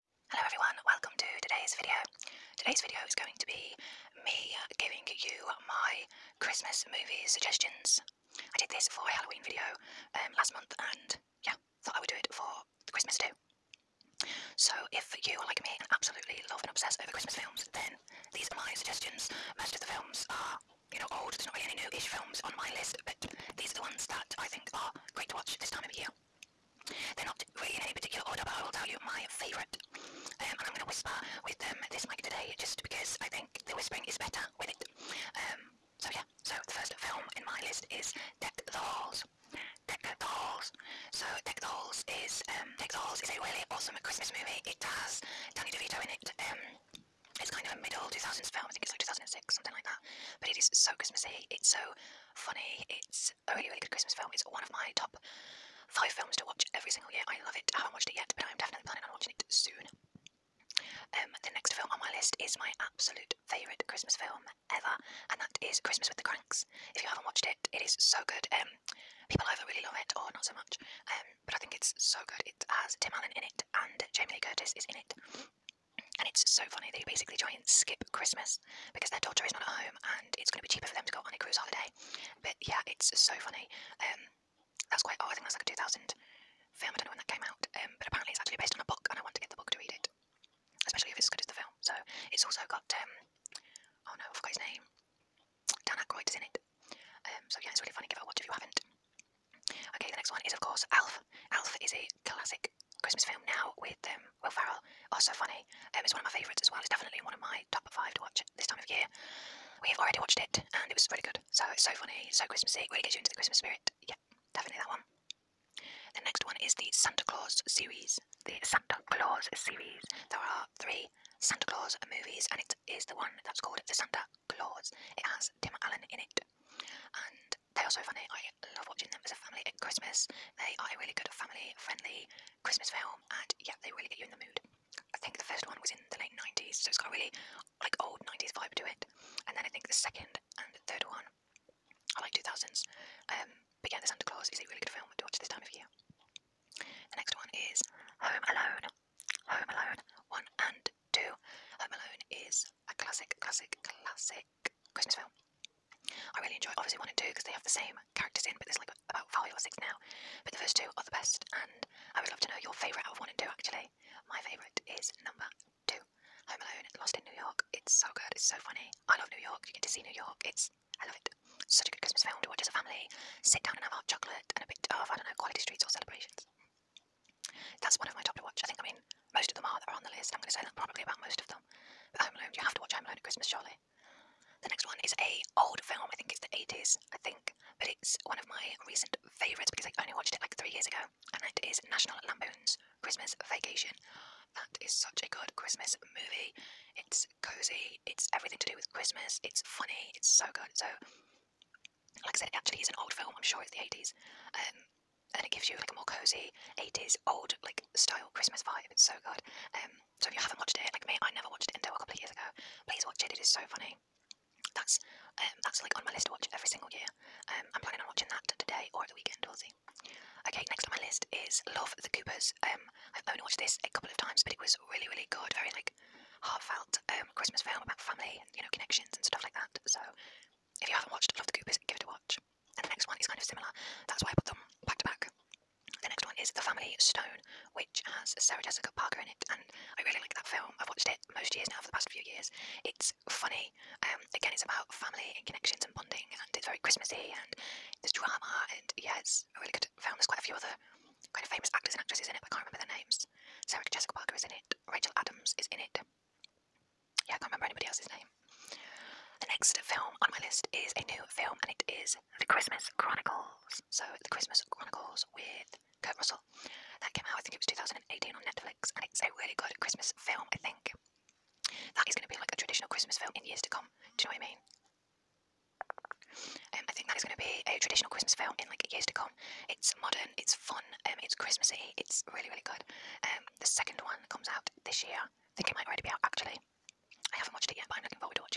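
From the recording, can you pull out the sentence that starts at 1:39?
Okay, the next one is of course Elf.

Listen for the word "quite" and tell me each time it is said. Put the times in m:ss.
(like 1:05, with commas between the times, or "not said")
1:25, 4:10.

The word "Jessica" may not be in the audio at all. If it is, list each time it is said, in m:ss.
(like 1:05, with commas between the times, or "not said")
3:58, 4:13.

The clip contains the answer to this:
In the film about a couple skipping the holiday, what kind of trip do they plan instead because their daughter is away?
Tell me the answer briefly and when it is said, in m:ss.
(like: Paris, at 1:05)
cruise holiday, at 1:21.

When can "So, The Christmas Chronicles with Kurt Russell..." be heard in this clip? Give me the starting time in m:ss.
4:23.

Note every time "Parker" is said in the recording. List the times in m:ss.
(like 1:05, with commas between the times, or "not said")
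3:58, 4:14.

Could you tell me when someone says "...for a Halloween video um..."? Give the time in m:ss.
0:08.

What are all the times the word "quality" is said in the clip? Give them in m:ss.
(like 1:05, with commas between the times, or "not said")
2:55.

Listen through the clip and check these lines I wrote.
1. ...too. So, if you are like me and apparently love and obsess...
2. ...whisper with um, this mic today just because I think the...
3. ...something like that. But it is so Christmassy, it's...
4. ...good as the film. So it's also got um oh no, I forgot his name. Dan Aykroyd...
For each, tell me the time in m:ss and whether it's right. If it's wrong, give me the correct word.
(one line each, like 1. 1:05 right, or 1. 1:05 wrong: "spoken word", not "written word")
1. 0:13 wrong: "absolutely", not "apparently"
2. 0:30 right
3. 0:49 right
4. 1:31 right.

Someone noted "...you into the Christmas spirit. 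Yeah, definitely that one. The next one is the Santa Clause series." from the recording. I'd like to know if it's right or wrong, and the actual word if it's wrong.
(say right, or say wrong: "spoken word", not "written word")
right.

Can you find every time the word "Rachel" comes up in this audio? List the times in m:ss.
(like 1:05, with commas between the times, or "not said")
4:14.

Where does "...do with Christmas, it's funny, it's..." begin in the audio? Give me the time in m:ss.
3:18.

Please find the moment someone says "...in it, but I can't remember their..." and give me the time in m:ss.
4:12.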